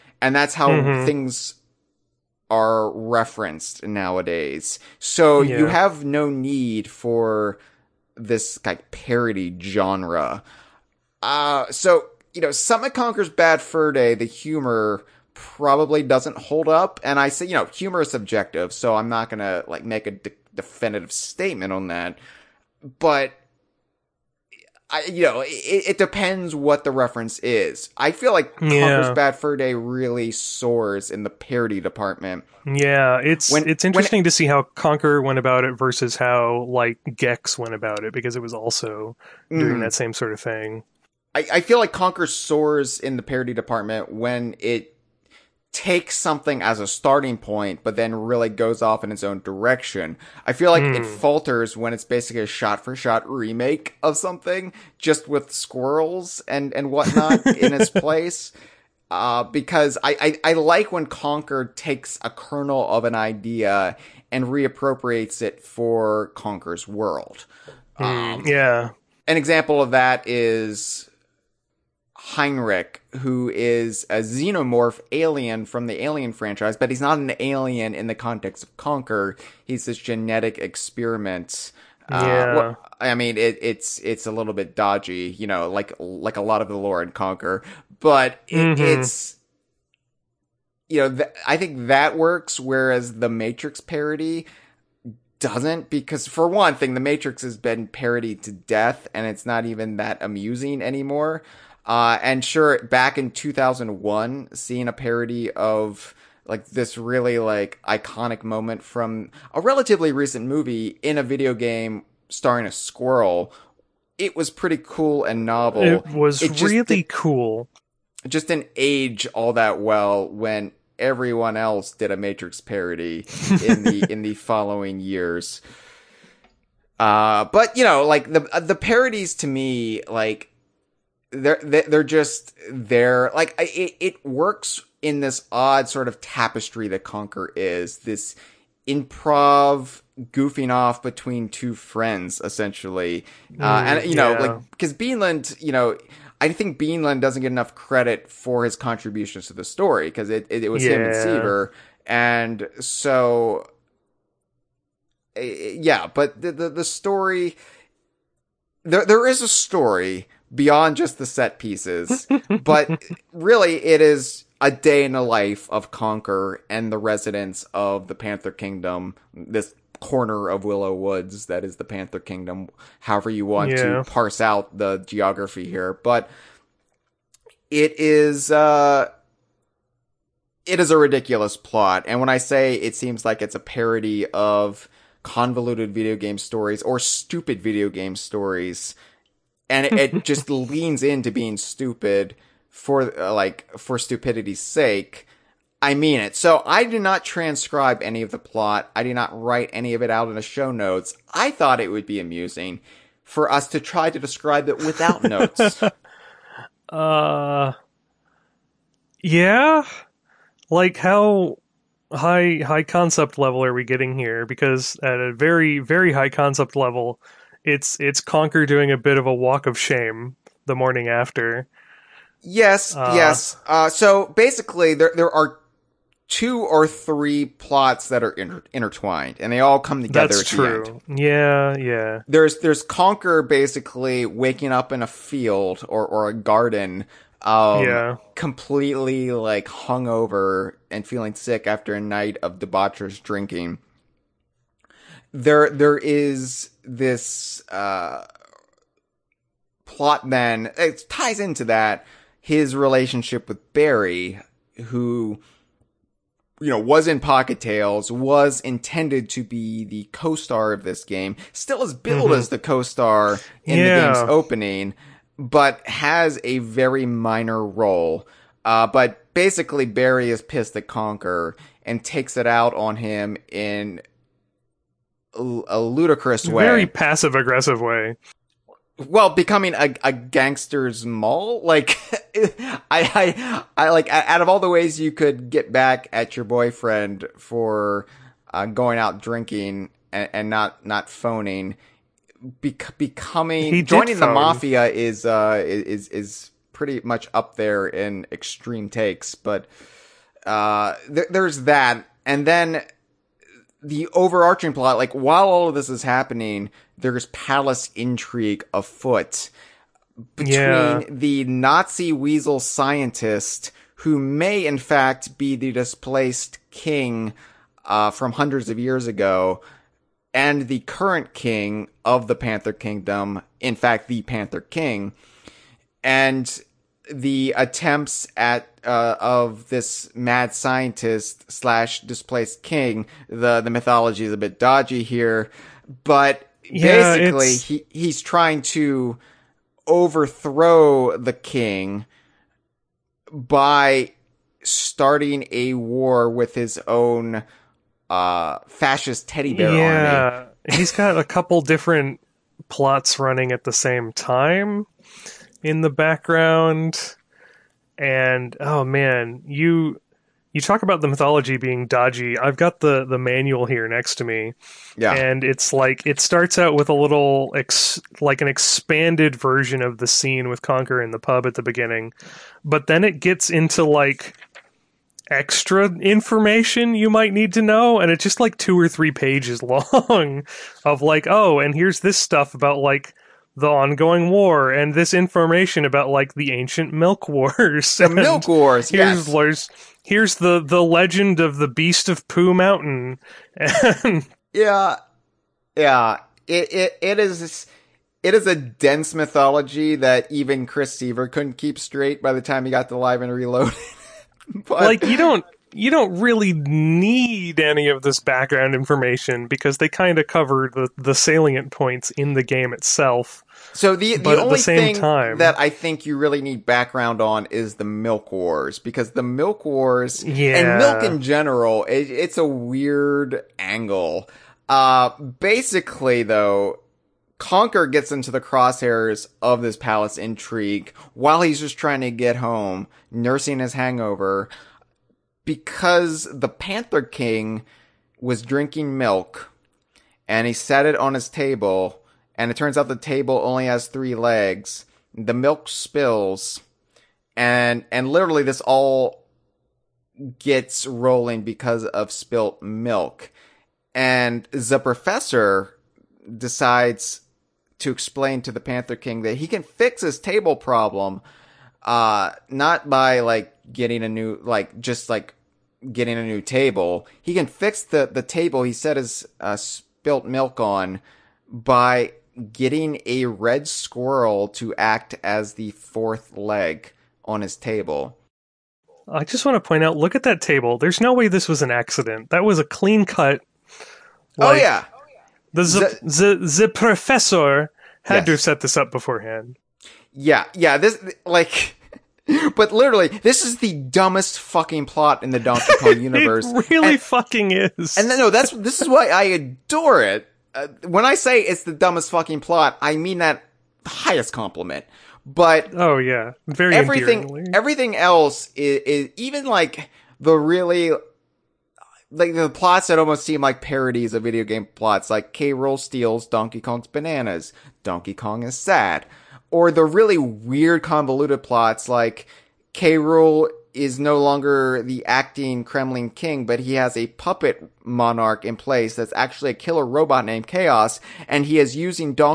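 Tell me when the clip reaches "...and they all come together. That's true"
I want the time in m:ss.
3:49.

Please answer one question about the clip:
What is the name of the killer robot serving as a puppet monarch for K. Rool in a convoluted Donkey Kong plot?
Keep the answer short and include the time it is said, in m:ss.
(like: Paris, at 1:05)
KAOS, at 8:50.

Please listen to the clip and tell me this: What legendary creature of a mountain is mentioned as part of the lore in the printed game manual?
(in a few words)
Beast of Pooh Mountain.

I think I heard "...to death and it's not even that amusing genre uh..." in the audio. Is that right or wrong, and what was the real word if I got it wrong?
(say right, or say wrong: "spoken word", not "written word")
wrong: "anymore", not "genre".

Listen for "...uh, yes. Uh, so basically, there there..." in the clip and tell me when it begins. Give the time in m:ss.
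3:42.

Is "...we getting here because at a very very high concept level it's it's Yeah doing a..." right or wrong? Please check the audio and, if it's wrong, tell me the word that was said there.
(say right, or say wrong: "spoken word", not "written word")
wrong: "Conker", not "Yeah".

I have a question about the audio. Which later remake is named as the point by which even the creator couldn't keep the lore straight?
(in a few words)
Live and Reloaded.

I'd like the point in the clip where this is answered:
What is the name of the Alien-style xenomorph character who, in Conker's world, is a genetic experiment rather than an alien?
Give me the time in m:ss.
1:12.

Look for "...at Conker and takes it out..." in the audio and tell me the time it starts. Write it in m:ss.
4:30.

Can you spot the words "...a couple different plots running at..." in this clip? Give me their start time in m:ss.
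5:51.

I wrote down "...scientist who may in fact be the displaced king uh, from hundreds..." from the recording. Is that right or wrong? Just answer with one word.
right.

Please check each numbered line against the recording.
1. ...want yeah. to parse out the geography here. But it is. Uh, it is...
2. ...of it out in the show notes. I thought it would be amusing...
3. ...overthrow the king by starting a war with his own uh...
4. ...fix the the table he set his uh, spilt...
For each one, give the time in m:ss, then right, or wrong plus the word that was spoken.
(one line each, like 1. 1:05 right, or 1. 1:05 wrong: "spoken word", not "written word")
1. 2:53 right
2. 3:19 right
3. 5:39 right
4. 7:47 right.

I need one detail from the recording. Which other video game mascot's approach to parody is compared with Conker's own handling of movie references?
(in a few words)
Gex.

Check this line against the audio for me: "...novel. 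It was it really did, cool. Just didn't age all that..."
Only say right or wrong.
right.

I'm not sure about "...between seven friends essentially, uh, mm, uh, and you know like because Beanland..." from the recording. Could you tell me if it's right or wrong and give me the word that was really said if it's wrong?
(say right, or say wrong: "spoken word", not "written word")
wrong: "two", not "seven".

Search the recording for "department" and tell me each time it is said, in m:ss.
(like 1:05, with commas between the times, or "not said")
0:31, 0:43.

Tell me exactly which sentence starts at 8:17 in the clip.
And no, that's this is why I adore it.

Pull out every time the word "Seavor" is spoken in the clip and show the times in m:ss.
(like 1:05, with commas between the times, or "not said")
2:31, 6:40.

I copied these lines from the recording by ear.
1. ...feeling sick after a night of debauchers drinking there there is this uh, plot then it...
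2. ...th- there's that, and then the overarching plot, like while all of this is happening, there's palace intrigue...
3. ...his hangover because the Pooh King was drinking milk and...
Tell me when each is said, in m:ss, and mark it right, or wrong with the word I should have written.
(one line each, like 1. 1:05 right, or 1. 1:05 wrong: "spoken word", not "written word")
1. 4:01 right
2. 5:01 right
3. 7:13 wrong: "Panther", not "Pooh".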